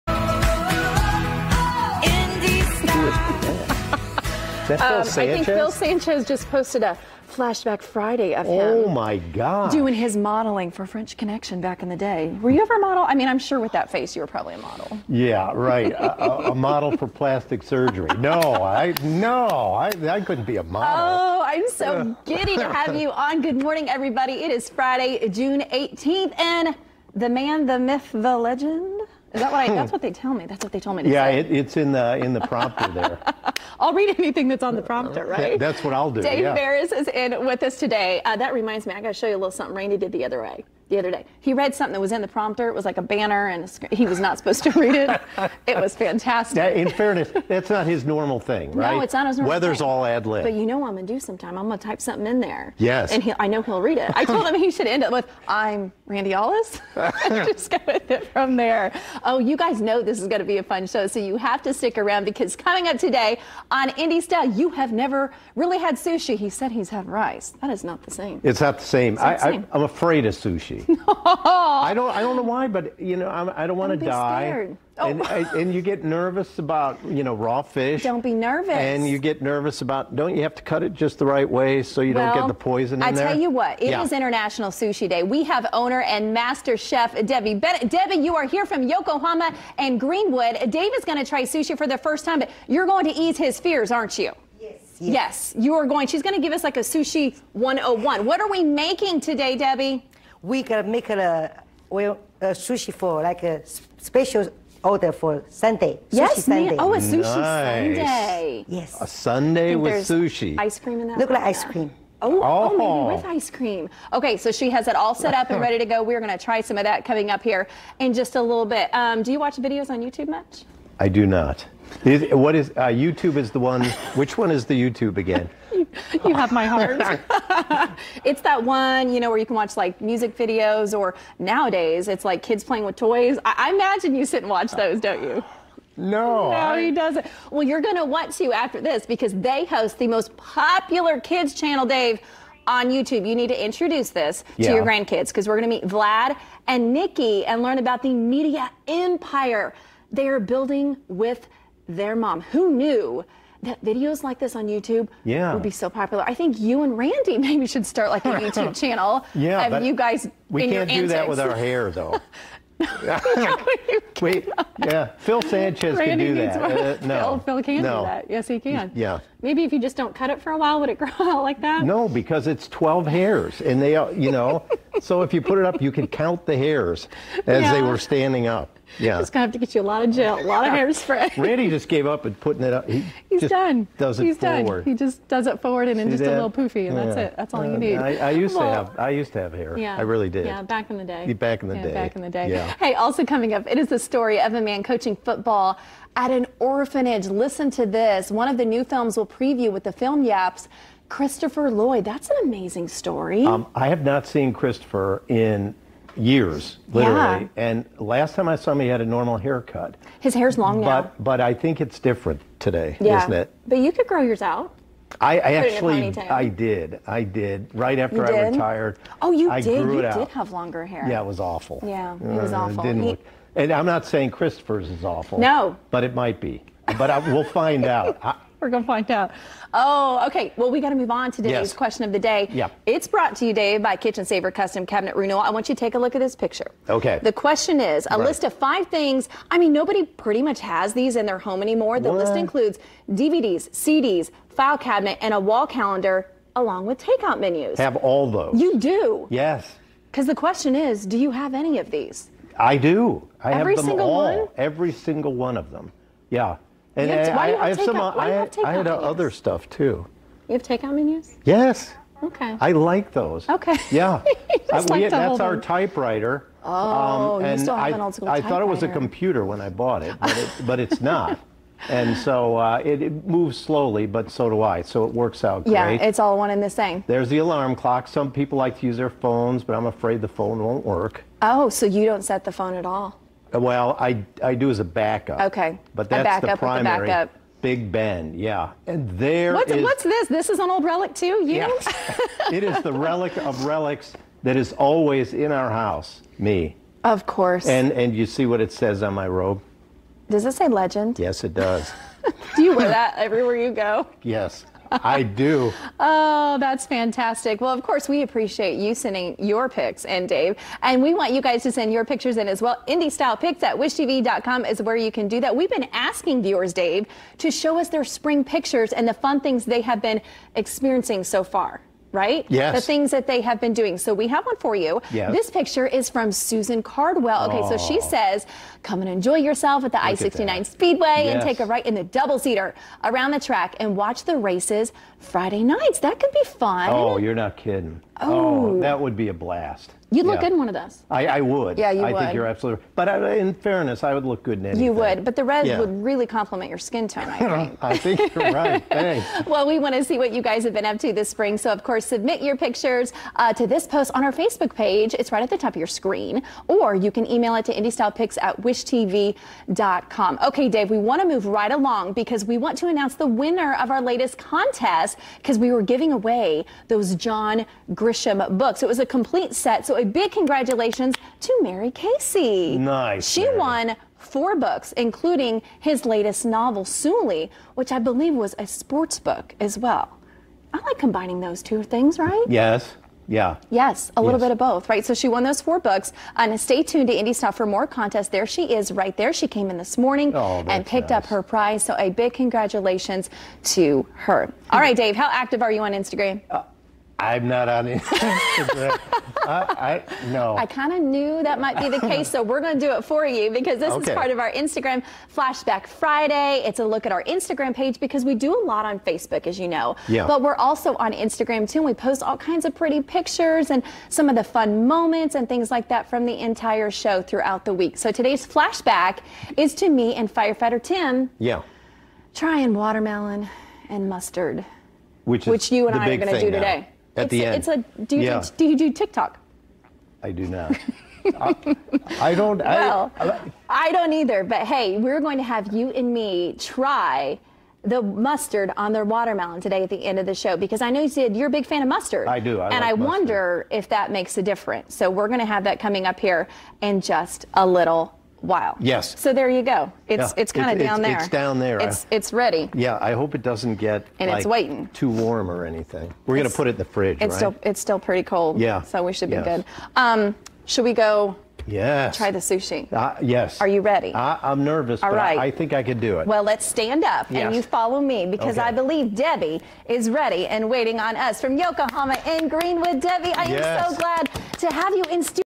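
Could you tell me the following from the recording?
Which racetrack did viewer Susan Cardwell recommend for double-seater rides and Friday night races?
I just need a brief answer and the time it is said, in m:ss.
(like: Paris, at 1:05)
I 69 Speedway, at 5:30.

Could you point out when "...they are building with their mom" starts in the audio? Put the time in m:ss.
2:30.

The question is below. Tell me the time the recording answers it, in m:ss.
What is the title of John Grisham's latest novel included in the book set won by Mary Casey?
6:16.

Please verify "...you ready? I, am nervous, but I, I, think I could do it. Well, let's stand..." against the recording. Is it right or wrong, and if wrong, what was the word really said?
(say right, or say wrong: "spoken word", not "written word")
right.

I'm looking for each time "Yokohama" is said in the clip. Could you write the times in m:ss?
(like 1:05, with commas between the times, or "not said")
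1:28, 7:51.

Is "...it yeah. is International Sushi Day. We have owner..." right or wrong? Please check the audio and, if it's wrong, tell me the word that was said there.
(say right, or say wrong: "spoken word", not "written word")
right.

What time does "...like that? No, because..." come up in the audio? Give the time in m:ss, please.
2:51.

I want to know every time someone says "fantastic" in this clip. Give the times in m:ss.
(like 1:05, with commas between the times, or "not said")
0:45, 5:06.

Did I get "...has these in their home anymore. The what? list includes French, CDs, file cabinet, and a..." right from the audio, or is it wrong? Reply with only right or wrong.
wrong.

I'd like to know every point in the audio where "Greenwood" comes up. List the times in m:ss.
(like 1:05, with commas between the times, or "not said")
1:29, 7:52.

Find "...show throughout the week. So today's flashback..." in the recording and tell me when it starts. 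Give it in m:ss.
6:56.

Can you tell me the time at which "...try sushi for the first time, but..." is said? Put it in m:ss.
1:31.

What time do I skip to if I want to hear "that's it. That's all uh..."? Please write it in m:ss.
3:07.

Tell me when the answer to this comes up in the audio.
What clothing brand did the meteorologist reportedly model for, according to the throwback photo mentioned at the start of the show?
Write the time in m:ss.
0:10.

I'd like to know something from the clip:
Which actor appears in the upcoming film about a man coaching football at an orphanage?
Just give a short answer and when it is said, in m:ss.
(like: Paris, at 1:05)
Christopher Lloyd, at 3:21.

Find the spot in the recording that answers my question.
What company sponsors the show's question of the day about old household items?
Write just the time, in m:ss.
3:53.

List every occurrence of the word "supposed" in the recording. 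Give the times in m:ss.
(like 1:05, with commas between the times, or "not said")
0:44.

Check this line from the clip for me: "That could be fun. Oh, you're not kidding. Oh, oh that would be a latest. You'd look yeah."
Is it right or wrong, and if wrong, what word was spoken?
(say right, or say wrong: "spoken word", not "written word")
wrong: "blast", not "latest".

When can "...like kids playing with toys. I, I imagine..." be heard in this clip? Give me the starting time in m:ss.
2:12.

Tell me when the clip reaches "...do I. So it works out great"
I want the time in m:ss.
4:34.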